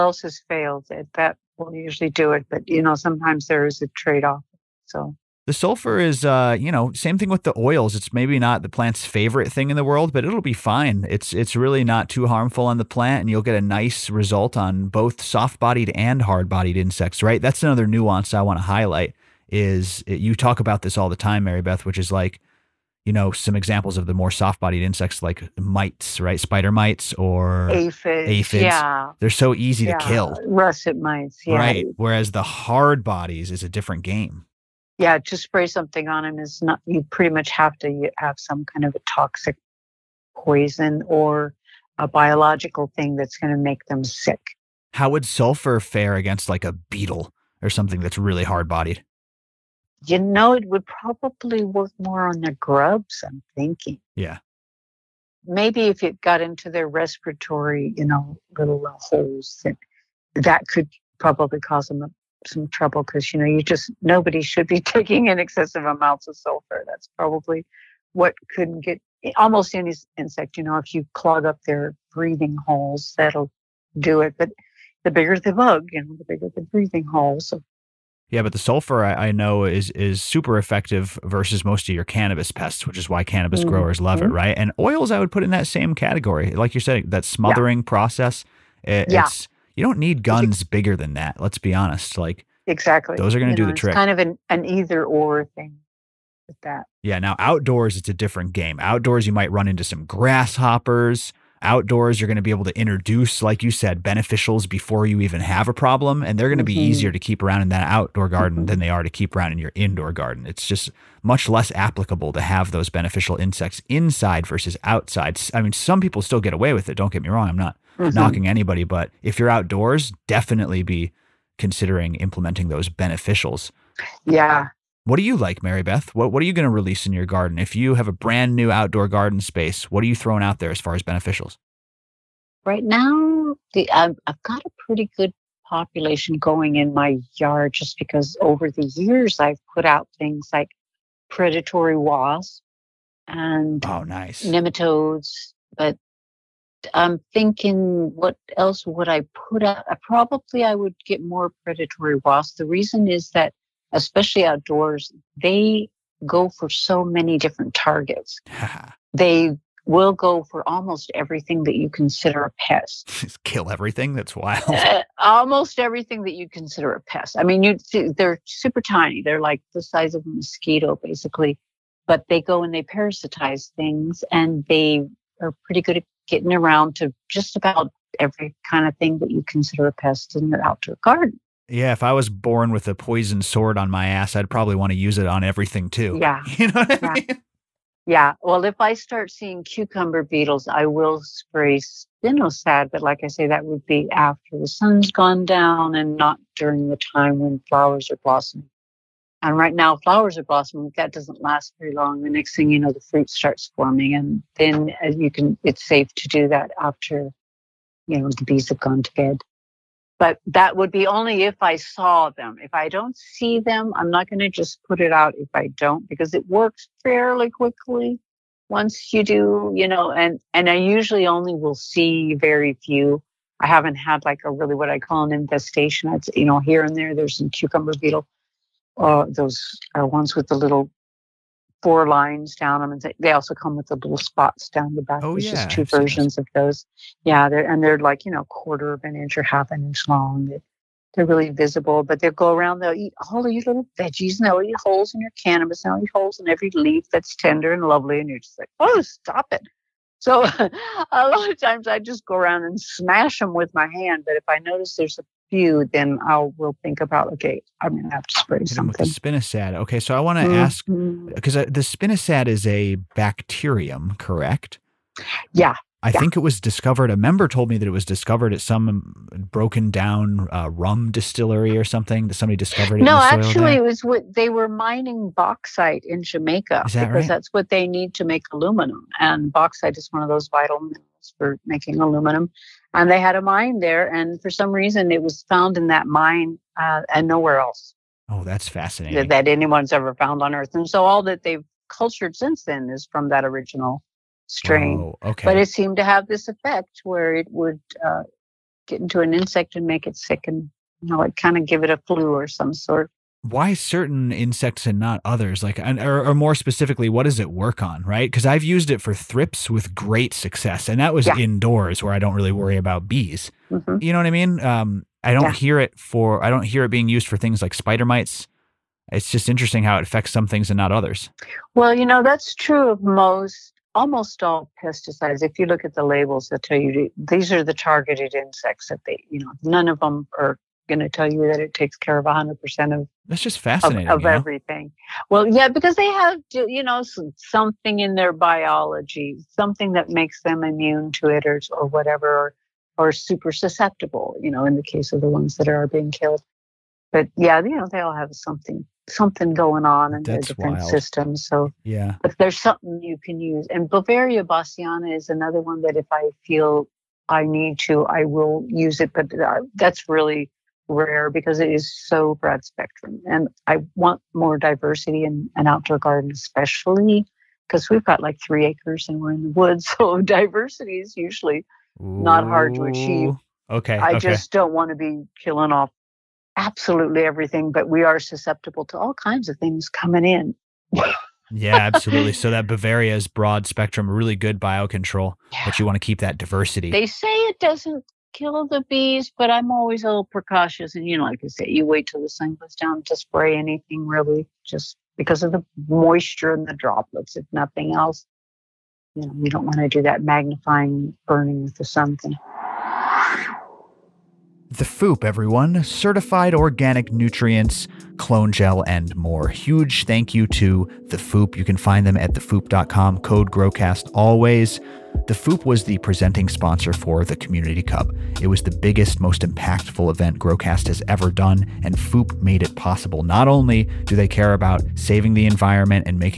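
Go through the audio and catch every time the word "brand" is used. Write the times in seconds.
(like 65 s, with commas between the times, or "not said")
128 s.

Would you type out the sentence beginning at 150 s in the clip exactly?
Probably I would get more predatory wasps.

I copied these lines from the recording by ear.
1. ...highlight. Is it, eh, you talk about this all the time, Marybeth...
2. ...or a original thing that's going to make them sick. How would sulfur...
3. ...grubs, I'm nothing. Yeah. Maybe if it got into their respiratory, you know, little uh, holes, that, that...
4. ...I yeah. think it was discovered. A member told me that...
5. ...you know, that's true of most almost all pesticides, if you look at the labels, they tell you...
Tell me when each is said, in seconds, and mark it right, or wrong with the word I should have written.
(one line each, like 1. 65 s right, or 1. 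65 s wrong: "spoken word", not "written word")
1. 18 s right
2. 41 s wrong: "biological", not "original"
3. 52 s wrong: "thinking", not "nothing"
4. 266 s right
5. 321 s right.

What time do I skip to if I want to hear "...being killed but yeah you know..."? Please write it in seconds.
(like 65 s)
345 s.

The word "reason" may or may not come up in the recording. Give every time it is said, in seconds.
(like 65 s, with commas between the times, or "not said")
152 s, 284 s.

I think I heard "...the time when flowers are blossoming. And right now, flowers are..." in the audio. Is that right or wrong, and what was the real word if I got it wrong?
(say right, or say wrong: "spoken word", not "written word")
right.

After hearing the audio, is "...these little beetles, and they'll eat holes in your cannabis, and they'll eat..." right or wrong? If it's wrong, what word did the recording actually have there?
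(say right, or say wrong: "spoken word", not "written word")
wrong: "veggies", not "beetles".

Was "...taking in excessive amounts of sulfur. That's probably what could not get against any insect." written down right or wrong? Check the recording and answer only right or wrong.
wrong.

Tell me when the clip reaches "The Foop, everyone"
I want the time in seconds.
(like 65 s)
404 s.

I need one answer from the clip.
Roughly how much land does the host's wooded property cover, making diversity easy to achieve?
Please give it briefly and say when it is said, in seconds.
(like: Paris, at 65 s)
3 acres, at 368 s.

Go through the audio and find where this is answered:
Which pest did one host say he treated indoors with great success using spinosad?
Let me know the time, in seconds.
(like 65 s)
309 s.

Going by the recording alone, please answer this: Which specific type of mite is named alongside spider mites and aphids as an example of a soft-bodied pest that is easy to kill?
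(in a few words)
Russet mites.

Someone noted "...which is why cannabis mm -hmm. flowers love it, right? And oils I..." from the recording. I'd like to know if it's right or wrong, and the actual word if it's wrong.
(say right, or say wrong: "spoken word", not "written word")
wrong: "growers", not "flowers".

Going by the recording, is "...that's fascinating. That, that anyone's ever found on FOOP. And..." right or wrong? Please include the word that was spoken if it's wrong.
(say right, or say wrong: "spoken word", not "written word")
wrong: "Earth", not "FOOP".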